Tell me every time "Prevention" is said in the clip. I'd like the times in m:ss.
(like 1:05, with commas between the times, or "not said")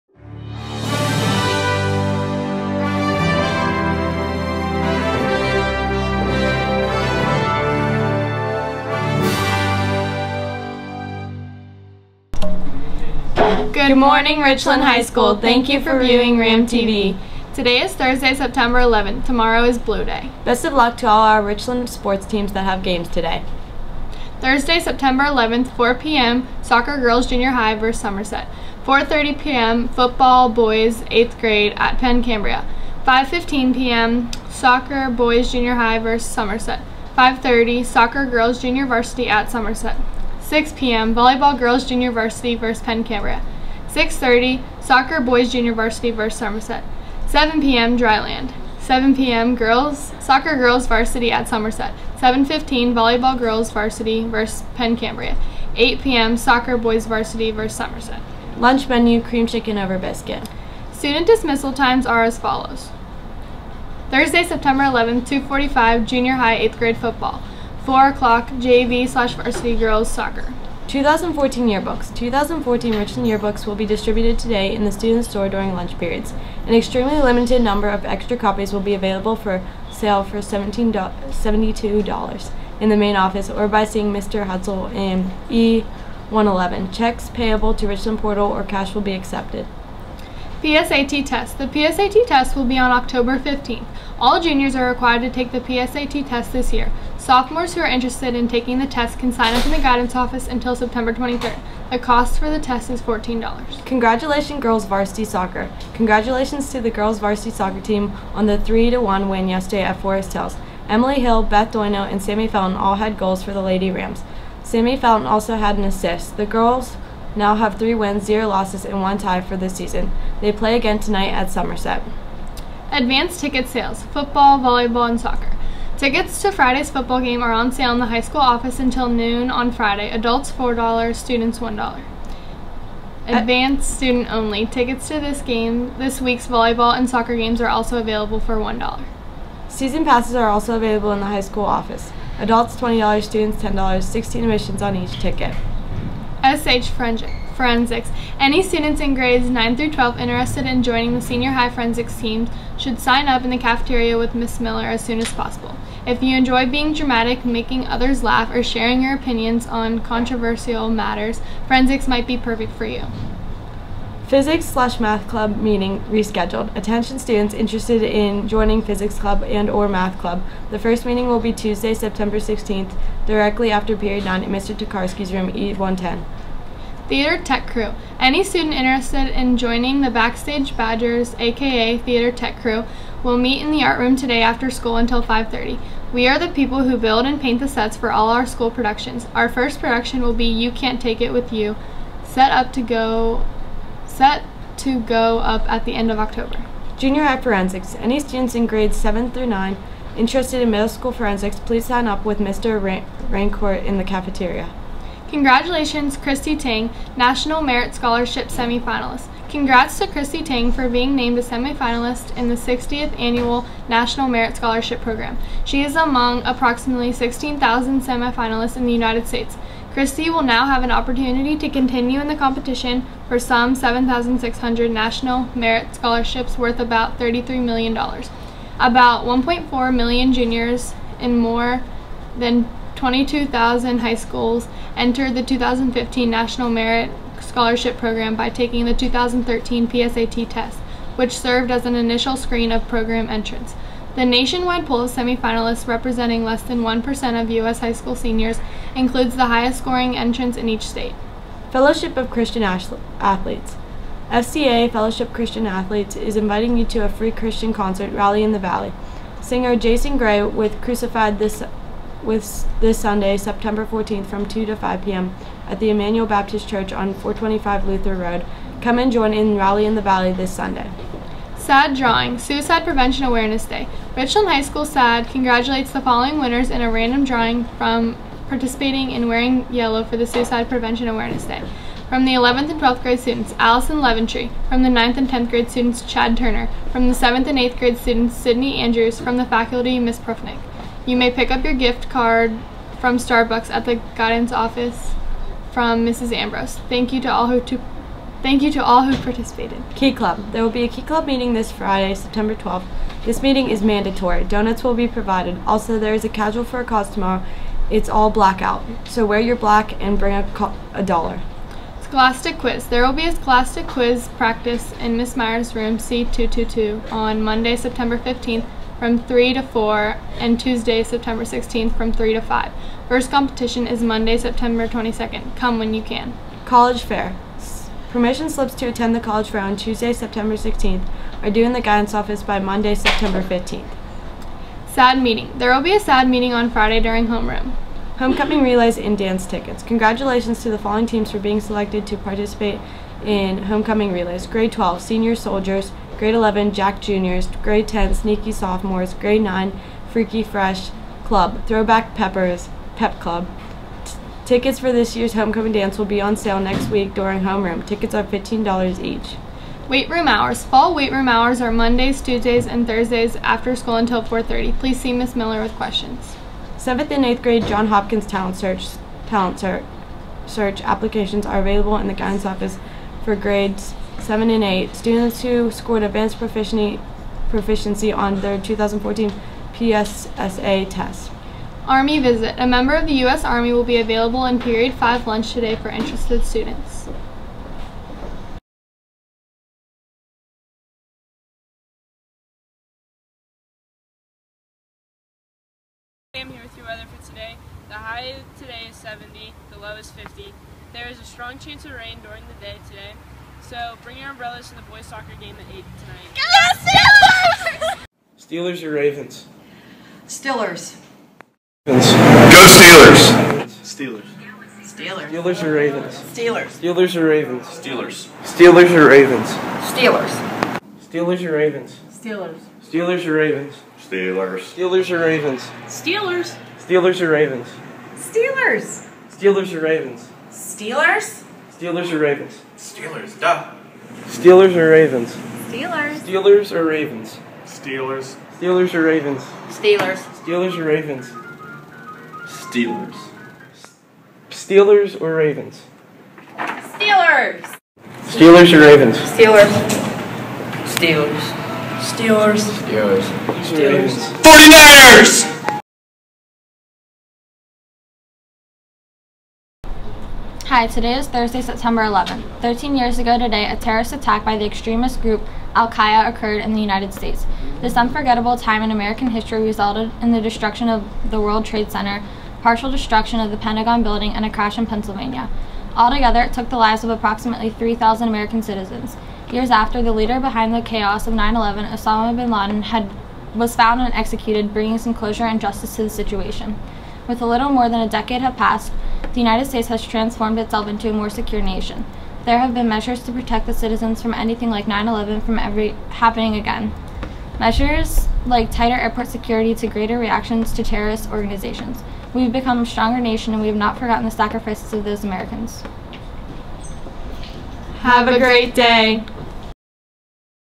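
4:32, 4:40.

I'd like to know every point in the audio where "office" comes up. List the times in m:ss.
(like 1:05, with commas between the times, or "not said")
1:23, 1:40, 2:08, 2:21, 4:54, 5:32, 6:12.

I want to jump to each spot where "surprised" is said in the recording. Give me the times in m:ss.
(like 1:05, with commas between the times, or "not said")
not said.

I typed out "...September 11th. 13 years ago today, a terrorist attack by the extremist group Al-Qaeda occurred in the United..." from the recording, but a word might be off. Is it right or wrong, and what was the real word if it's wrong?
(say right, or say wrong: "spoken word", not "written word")
right.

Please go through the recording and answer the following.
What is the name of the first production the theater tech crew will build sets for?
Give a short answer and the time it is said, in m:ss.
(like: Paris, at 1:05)
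You Can't Take It With You, at 3:10.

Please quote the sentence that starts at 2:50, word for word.
The first meeting will be Tuesday, September 16th, directly after period 9 at Mr.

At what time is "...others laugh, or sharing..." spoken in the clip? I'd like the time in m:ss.
2:37.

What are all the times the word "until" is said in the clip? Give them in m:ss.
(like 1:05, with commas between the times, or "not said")
1:40, 2:08, 3:04, 6:03.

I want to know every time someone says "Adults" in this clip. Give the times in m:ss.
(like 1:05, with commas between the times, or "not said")
2:10, 2:22.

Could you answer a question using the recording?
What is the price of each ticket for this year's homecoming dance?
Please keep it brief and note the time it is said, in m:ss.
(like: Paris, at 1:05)
$15, at 5:58.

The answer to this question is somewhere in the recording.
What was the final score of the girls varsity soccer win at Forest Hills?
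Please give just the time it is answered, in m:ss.
1:48.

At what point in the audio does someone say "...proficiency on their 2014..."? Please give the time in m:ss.
6:17.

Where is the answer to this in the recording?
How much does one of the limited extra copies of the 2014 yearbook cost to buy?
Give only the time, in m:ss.
1:20.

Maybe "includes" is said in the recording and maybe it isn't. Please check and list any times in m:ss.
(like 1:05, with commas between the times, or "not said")
4:08.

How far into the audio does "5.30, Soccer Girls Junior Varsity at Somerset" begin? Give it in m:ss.
0:37.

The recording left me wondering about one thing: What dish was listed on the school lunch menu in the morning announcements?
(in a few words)
Cream chicken over biscuit.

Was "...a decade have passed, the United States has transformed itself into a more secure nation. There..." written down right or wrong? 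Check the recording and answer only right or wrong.
right.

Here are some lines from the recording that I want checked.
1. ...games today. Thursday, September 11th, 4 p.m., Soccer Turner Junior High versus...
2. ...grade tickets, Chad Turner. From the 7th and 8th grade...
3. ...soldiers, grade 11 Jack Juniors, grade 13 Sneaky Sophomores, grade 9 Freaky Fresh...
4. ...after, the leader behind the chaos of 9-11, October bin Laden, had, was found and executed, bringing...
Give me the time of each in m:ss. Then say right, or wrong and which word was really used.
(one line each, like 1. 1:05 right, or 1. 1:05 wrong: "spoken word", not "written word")
1. 0:22 wrong: "Girls", not "Turner"
2. 4:45 wrong: "students", not "tickets"
3. 5:45 wrong: "10", not "13"
4. 7:59 wrong: "Osama", not "October".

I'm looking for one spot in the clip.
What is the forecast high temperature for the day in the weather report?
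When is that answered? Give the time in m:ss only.
6:38.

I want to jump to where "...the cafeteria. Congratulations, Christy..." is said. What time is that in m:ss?
3:23.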